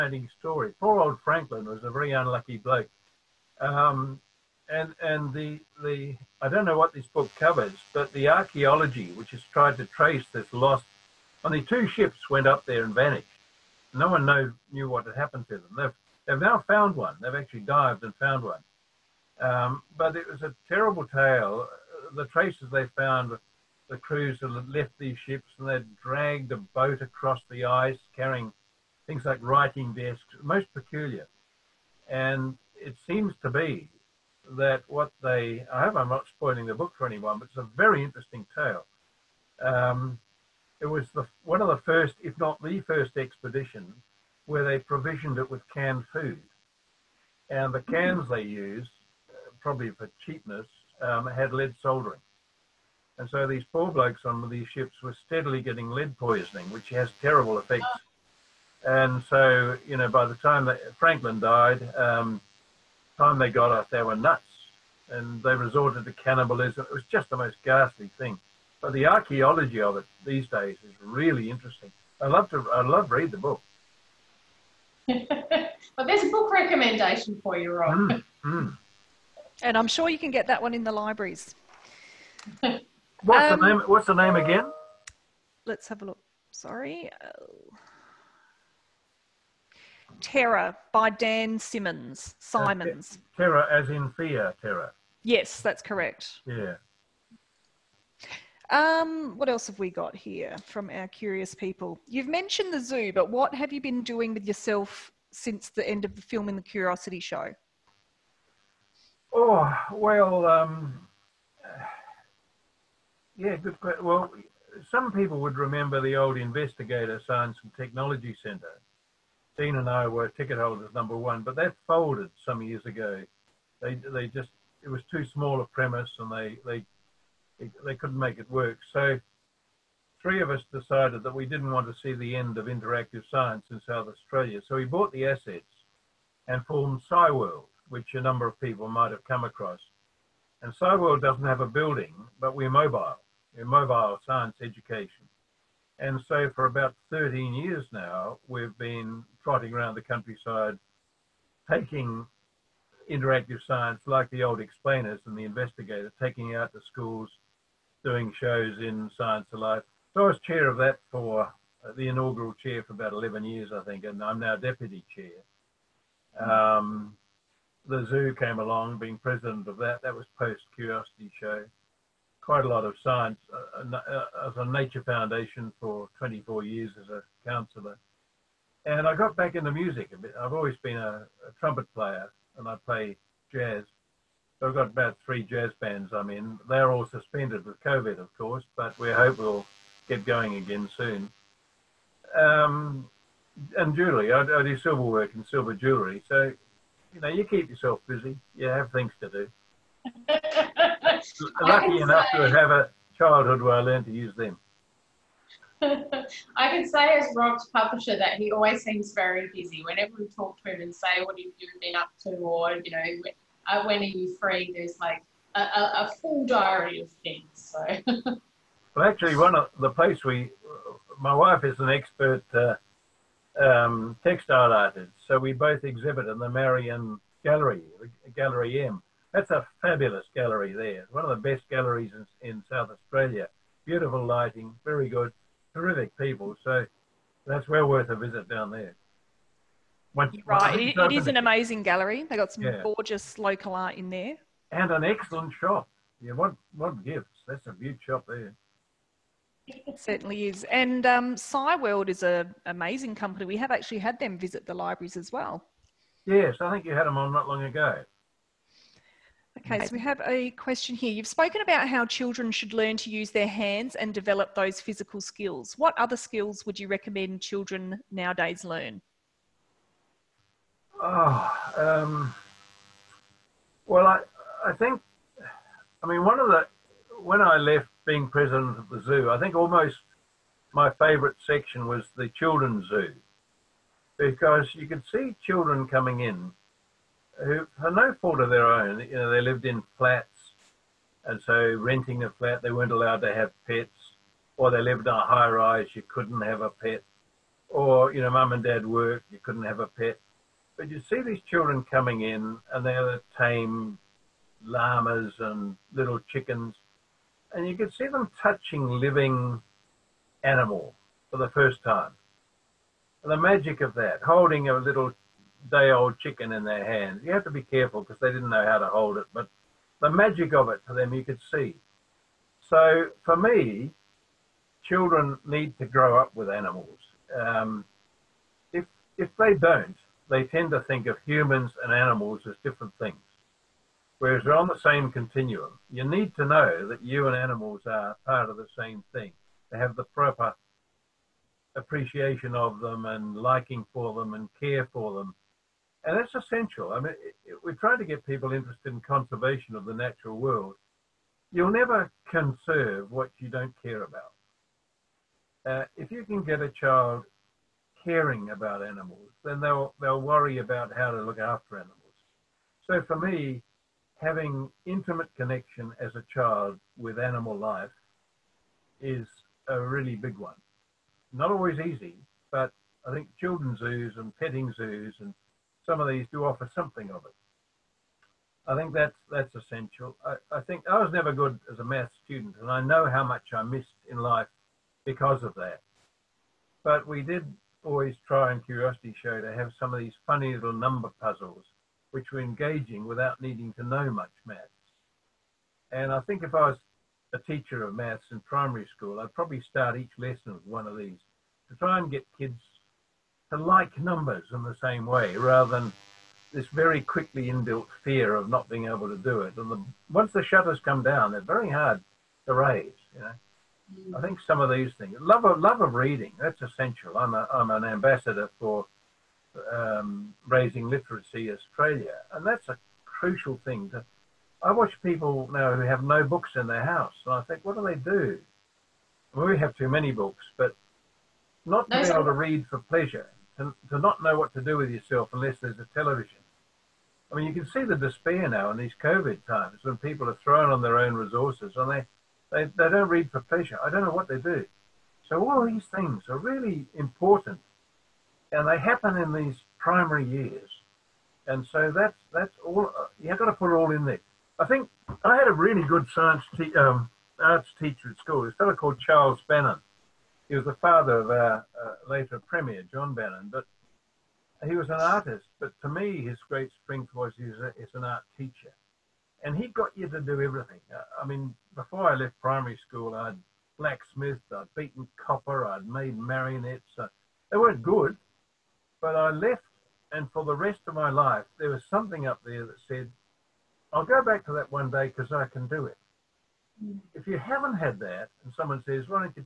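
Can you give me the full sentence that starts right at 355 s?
Uh, if you can get a child caring about animals, then they'll they'll worry about how to look after animals.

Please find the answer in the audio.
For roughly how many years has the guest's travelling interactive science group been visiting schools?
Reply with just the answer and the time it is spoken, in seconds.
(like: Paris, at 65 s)
13, at 147 s.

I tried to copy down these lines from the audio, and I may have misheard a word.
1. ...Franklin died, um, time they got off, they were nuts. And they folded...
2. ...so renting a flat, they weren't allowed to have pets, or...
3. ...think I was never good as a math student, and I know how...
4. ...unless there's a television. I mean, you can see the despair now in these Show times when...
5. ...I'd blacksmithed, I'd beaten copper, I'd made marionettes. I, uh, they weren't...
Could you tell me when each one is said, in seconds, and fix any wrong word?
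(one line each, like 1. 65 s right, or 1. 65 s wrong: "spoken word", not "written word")
1. 60 s wrong: "resorted", not "folded"
2. 291 s right
3. 380 s right
4. 435 s wrong: "COVID", not "Show"
5. 473 s right.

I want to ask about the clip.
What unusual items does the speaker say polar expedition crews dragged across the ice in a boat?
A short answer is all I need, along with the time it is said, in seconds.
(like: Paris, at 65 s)
writing desks, at 29 s.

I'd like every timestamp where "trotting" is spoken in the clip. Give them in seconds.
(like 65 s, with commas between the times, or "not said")
149 s.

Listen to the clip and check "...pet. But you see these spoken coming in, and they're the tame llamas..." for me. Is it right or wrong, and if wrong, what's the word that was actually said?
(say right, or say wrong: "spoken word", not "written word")
wrong: "children", not "spoken".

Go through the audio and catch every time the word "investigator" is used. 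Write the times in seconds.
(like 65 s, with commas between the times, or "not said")
116 s, 155 s.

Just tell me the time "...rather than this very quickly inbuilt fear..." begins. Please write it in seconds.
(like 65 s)
405 s.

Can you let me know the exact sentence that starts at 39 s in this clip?
Um, it was the, one of the first, if not the first expedition where they provisioned it with canned food.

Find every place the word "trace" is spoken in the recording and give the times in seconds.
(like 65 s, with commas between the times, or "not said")
9 s, 22 s.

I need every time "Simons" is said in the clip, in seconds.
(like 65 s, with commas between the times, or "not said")
92 s.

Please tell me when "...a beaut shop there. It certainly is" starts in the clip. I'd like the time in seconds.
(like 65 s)
247 s.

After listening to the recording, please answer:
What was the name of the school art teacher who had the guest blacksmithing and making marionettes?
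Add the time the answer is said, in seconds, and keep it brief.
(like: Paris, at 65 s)
Charles Bannon, at 459 s.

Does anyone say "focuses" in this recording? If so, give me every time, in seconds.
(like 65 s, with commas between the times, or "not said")
not said.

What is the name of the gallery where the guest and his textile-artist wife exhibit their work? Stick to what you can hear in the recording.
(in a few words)
Gallery M.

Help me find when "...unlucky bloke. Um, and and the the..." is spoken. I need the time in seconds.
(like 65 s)
2 s.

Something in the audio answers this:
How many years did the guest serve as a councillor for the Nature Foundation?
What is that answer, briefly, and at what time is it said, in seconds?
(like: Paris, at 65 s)
24, at 176 s.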